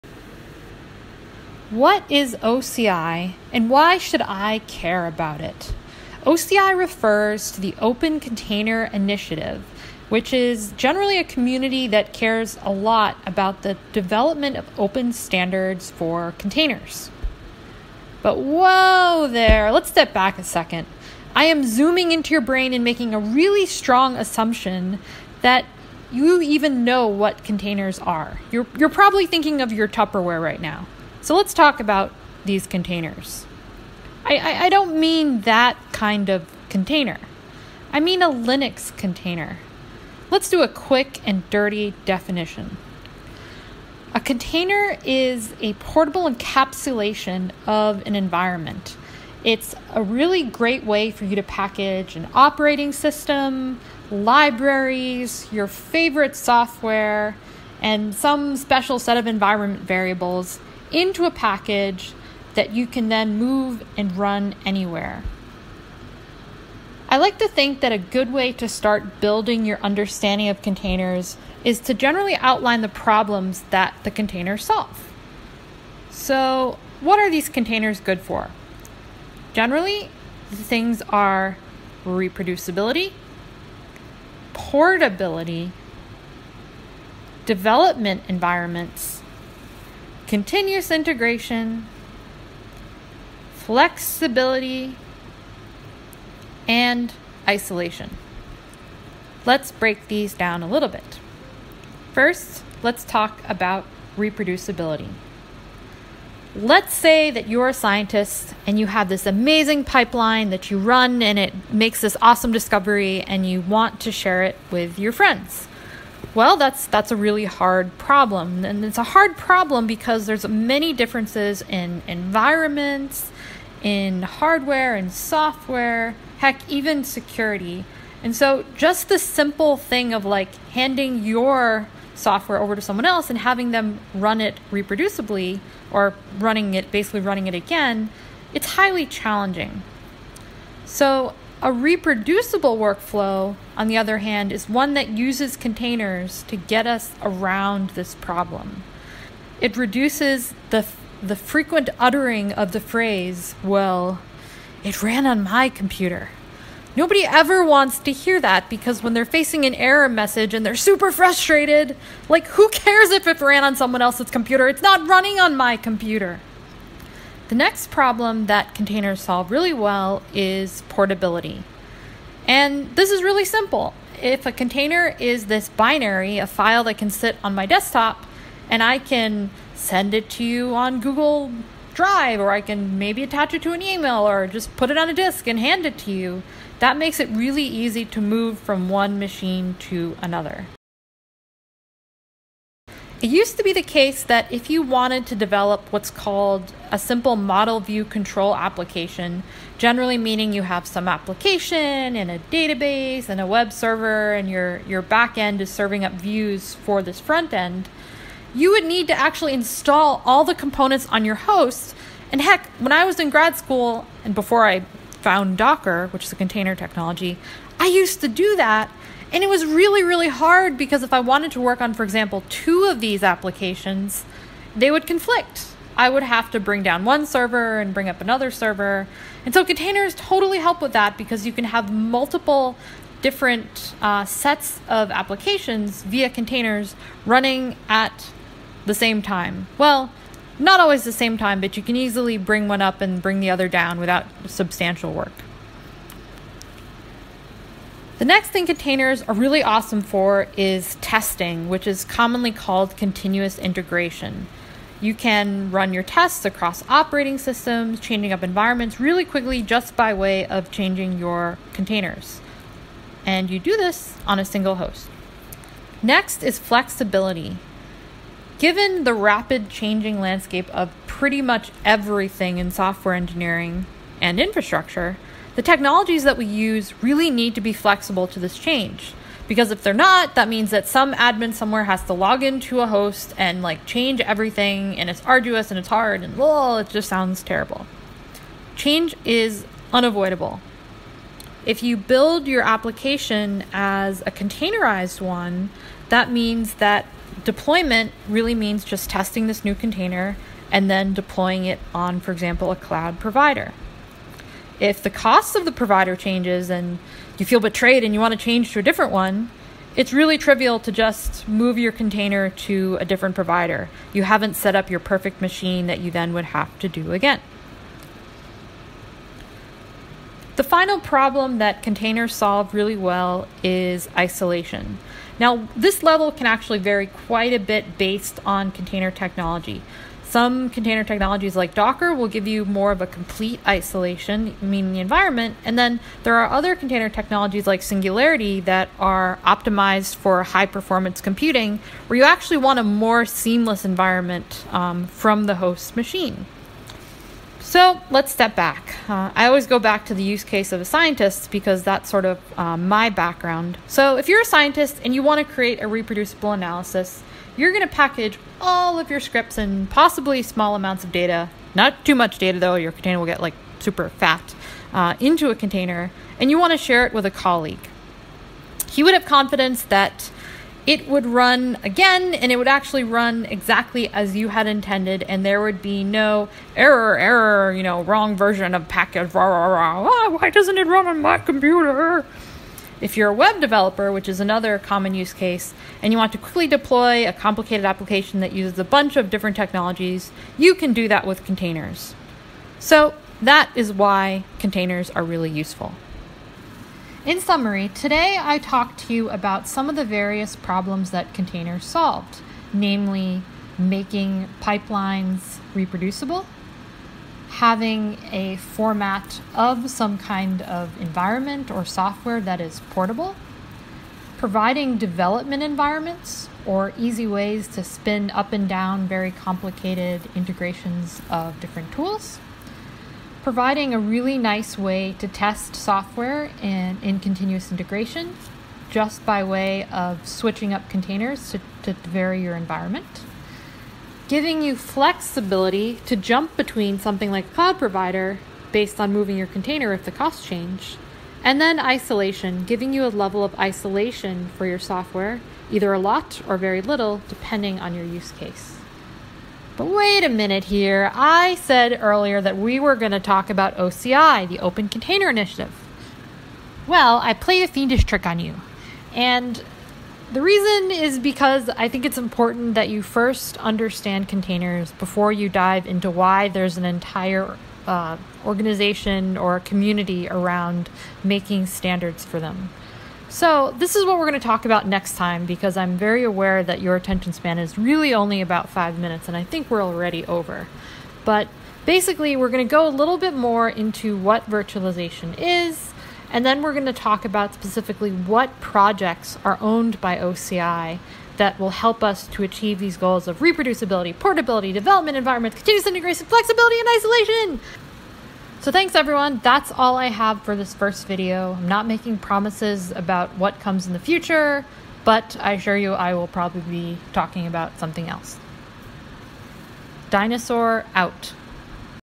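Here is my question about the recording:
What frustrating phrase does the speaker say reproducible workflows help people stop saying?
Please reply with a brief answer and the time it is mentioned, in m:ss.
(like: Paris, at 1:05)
it ran on my computer, at 2:34.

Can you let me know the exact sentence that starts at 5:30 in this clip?
Some container technologies like Docker will give you more of a complete isolation, meaning the environment.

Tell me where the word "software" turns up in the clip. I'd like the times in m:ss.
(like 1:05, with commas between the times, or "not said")
0:56, 2:05, 2:12, 4:32, 6:51, 7:05, 7:24.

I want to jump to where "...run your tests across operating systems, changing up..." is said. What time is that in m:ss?
4:15.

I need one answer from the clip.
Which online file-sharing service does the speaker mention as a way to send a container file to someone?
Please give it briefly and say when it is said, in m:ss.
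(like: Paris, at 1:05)
Google Drive, at 3:01.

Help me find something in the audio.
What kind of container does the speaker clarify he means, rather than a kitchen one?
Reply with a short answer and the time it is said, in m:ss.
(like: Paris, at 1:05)
Linux container, at 0:38.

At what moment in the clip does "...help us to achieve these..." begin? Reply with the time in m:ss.
8:11.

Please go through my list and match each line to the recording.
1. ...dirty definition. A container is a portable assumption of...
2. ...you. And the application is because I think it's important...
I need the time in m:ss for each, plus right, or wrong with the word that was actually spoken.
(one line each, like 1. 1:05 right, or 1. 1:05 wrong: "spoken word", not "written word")
1. 0:41 wrong: "encapsulation", not "assumption"
2. 7:38 wrong: "reason", not "application".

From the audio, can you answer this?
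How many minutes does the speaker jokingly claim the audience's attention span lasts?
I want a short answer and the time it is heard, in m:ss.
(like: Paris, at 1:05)
5, at 7:58.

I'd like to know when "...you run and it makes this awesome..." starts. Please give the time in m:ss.
1:50.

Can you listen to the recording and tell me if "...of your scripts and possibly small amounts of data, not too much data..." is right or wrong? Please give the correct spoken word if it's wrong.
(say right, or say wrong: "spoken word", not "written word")
right.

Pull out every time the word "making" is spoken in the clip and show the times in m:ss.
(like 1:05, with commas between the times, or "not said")
0:22, 6:43, 7:51, 8:21.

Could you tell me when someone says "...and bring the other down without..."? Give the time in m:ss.
4:02.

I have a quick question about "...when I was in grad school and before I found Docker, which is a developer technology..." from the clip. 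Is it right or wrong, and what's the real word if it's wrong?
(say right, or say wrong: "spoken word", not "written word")
wrong: "container", not "developer".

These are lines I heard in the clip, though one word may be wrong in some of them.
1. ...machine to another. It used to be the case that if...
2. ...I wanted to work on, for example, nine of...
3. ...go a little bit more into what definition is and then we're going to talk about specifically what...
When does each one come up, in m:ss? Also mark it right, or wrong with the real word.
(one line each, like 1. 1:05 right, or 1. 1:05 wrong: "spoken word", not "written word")
1. 3:09 right
2. 3:41 wrong: "two", not "nine"
3. 8:02 wrong: "virtualization", not "definition".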